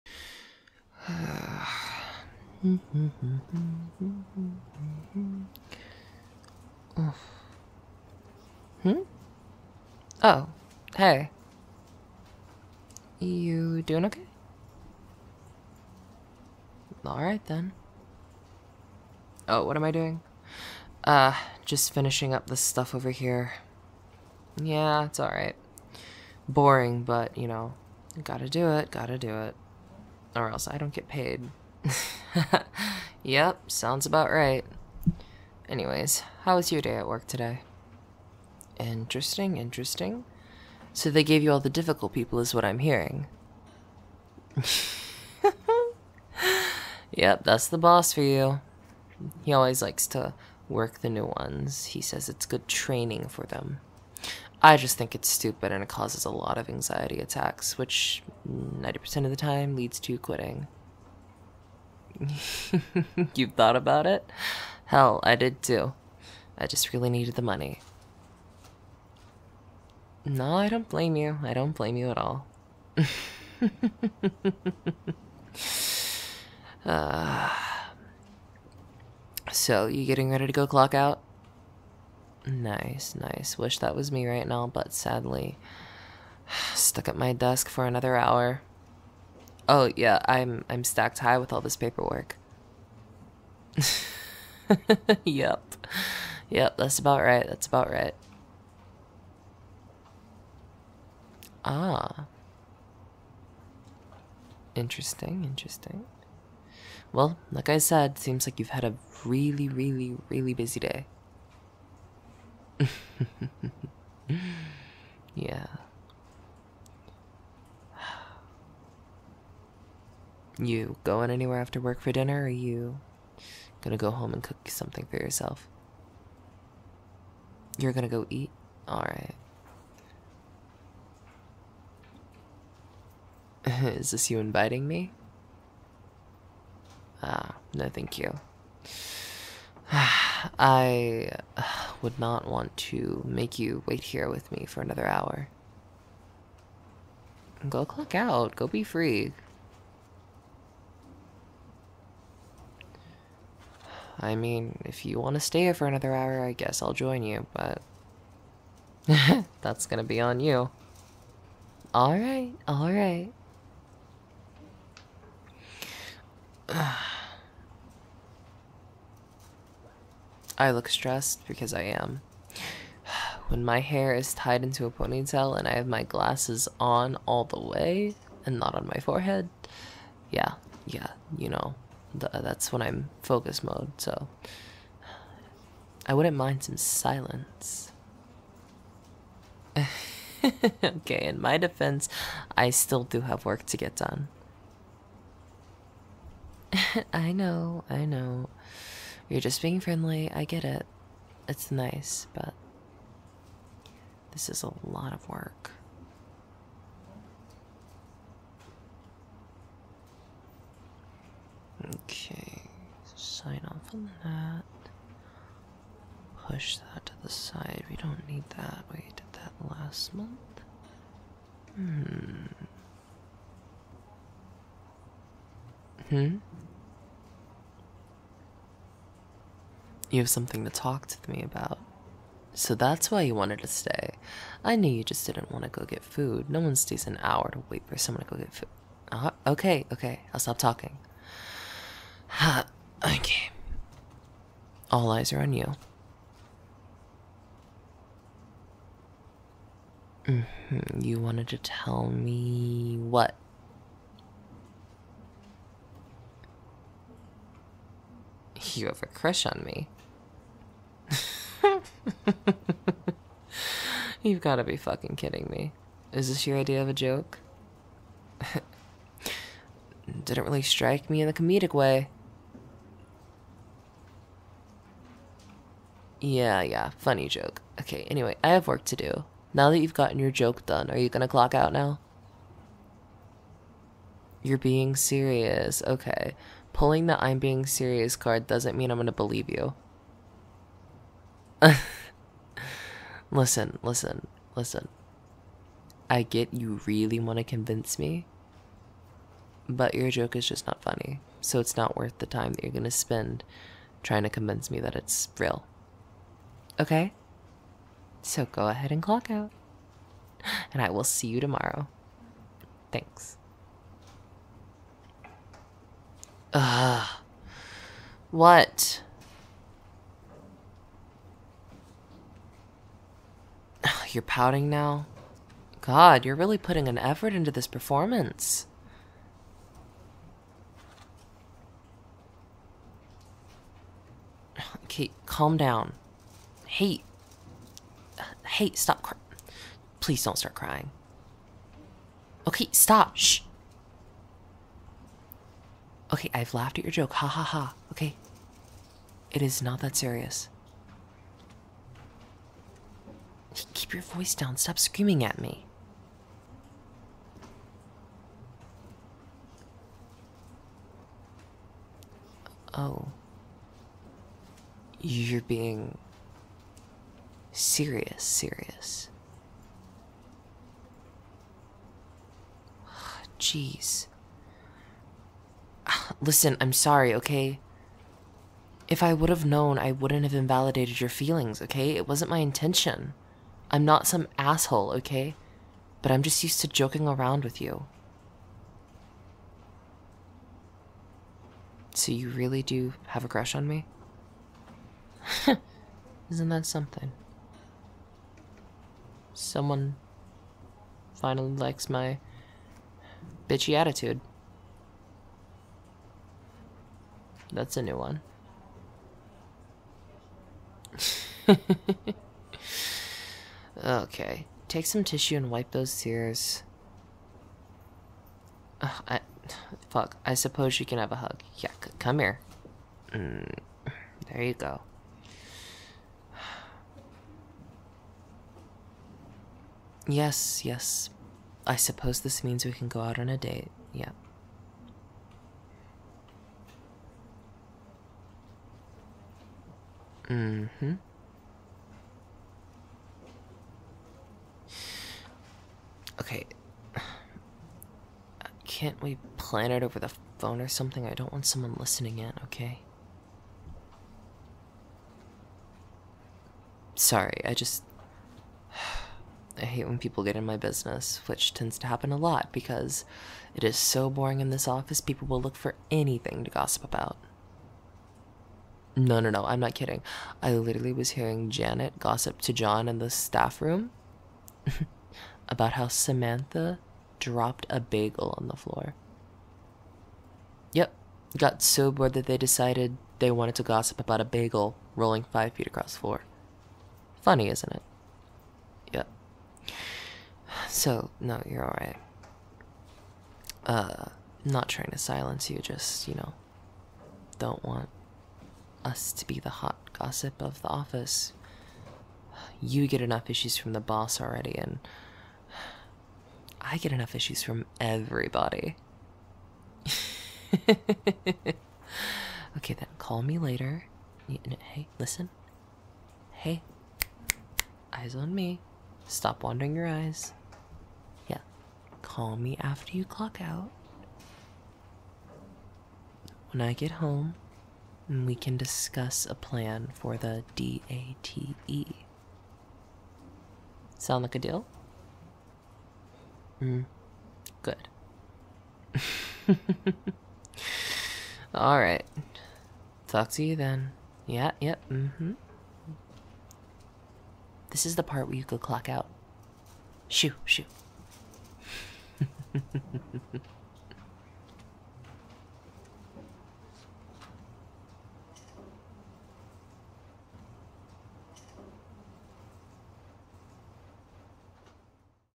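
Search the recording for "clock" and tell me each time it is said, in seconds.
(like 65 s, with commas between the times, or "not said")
80 s, 147 s, 281 s, 309 s, 523 s, 548 s.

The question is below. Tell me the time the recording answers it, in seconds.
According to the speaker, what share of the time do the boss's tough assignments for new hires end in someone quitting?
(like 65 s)
58 s.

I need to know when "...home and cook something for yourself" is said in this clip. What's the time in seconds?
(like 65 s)
124 s.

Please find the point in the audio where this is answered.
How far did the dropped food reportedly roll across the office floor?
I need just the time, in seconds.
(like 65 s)
485 s.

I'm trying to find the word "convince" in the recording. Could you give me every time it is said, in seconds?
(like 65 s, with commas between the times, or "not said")
297 s, 304 s.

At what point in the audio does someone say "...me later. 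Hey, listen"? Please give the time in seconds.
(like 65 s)
513 s.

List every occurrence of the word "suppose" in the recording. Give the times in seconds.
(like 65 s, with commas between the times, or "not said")
420 s, 431 s.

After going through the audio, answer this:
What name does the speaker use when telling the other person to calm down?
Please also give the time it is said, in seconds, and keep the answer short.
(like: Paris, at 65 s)
Kate, at 334 s.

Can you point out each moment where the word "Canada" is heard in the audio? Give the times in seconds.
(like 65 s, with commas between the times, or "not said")
not said.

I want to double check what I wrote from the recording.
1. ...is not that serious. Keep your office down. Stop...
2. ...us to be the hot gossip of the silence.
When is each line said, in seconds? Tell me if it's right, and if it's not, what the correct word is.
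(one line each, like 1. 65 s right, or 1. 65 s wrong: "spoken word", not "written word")
1. 349 s wrong: "voice", not "office"
2. 498 s wrong: "office", not "silence".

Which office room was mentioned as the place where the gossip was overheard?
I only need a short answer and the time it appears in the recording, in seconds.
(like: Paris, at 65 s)
the staff room, at 473 s.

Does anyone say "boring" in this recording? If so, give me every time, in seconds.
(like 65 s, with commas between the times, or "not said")
26 s, 464 s.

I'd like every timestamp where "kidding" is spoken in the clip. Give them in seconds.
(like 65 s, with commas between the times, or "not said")
265 s, 469 s.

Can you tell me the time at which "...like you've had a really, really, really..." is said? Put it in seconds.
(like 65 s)
108 s.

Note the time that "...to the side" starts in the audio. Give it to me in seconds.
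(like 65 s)
217 s.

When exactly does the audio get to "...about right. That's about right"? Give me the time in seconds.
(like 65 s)
96 s.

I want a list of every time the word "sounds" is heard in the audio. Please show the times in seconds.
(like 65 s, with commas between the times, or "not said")
33 s, 533 s.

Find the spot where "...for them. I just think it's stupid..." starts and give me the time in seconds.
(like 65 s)
53 s.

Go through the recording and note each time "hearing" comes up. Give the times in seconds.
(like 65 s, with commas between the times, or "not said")
42 s, 471 s.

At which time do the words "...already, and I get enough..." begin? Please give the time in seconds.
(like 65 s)
504 s.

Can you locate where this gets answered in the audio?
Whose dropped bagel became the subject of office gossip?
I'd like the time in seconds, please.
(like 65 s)
475 s.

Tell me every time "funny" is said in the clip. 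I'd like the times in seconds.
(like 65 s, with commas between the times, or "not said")
276 s, 300 s, 487 s.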